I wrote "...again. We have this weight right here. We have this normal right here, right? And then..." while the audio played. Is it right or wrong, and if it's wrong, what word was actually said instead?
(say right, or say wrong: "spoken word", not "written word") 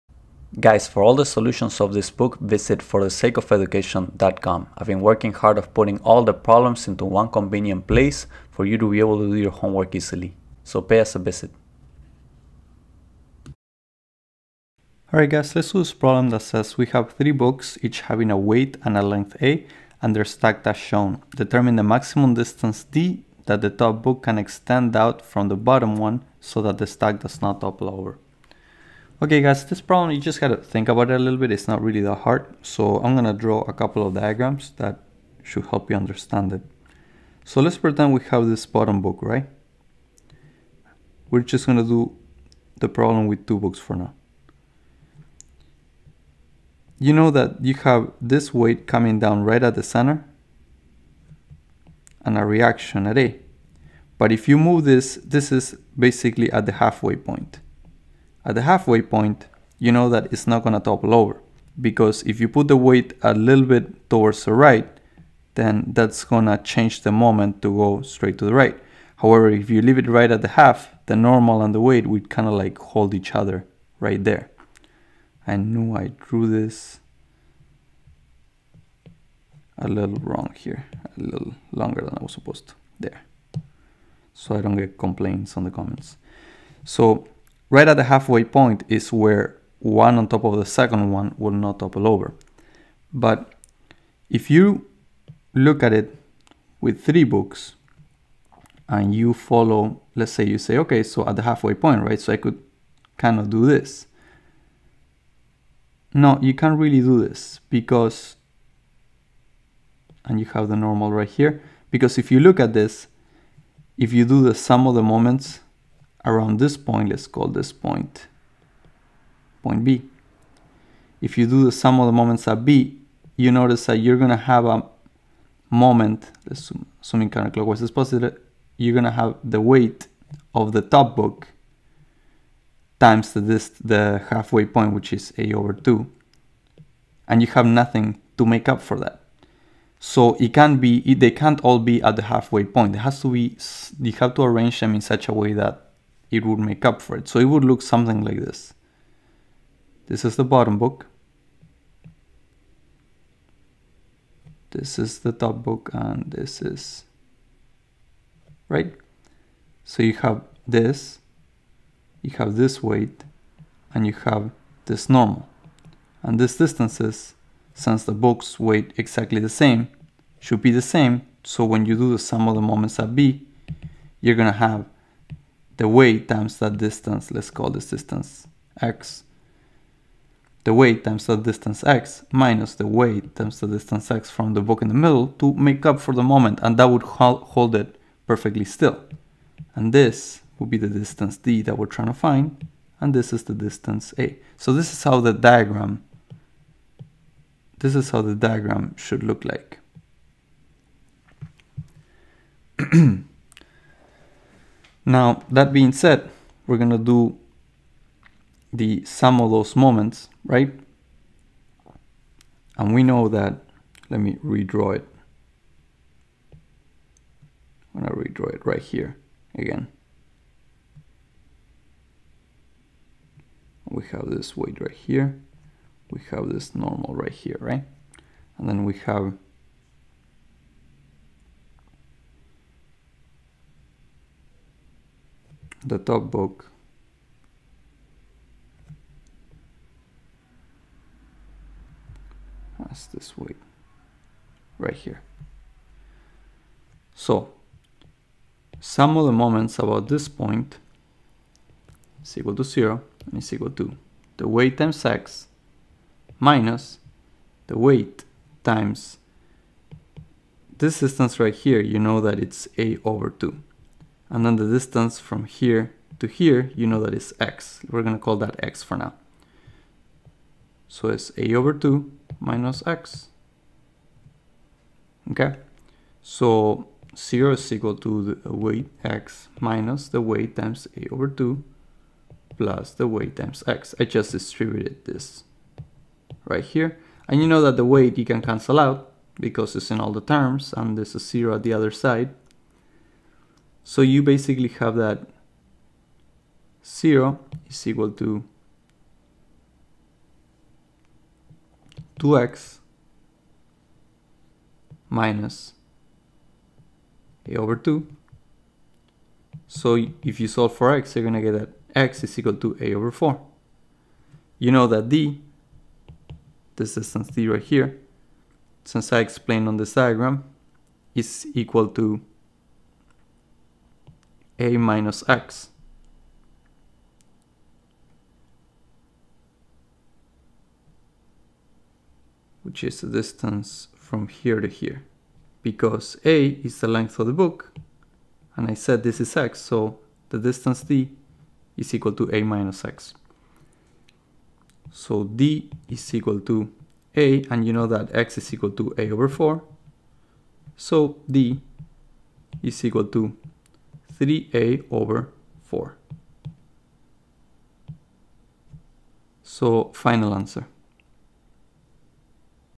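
right.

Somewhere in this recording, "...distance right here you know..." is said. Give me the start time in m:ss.
4:20.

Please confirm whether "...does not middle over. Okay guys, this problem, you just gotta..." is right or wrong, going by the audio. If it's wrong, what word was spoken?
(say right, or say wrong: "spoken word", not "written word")
wrong: "topple", not "middle".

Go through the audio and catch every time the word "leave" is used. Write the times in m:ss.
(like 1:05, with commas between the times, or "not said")
1:09.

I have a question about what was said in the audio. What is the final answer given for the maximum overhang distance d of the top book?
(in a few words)
3a/4.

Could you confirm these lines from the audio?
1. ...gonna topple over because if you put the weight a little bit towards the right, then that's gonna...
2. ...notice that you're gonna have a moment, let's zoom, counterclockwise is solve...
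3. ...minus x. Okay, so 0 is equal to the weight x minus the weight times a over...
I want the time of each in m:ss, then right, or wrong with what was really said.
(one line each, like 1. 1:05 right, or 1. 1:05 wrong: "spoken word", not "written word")
1. 1:00 right
2. 2:03 wrong: "positive", not "solve"
3. 4:32 right.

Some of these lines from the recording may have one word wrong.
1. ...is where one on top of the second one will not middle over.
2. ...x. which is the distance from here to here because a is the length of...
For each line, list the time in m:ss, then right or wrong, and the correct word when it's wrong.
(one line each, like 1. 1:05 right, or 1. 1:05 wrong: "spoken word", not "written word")
1. 1:28 wrong: "topple", not "middle"
2. 5:25 right.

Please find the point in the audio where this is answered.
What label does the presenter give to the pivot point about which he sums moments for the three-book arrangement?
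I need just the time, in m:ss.
1:59.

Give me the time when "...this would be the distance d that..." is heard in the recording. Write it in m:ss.
3:09.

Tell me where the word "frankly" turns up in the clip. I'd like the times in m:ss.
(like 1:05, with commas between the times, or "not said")
not said.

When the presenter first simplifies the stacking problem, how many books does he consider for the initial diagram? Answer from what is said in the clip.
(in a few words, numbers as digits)
2.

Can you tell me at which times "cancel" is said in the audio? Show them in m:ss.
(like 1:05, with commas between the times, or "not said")
4:48.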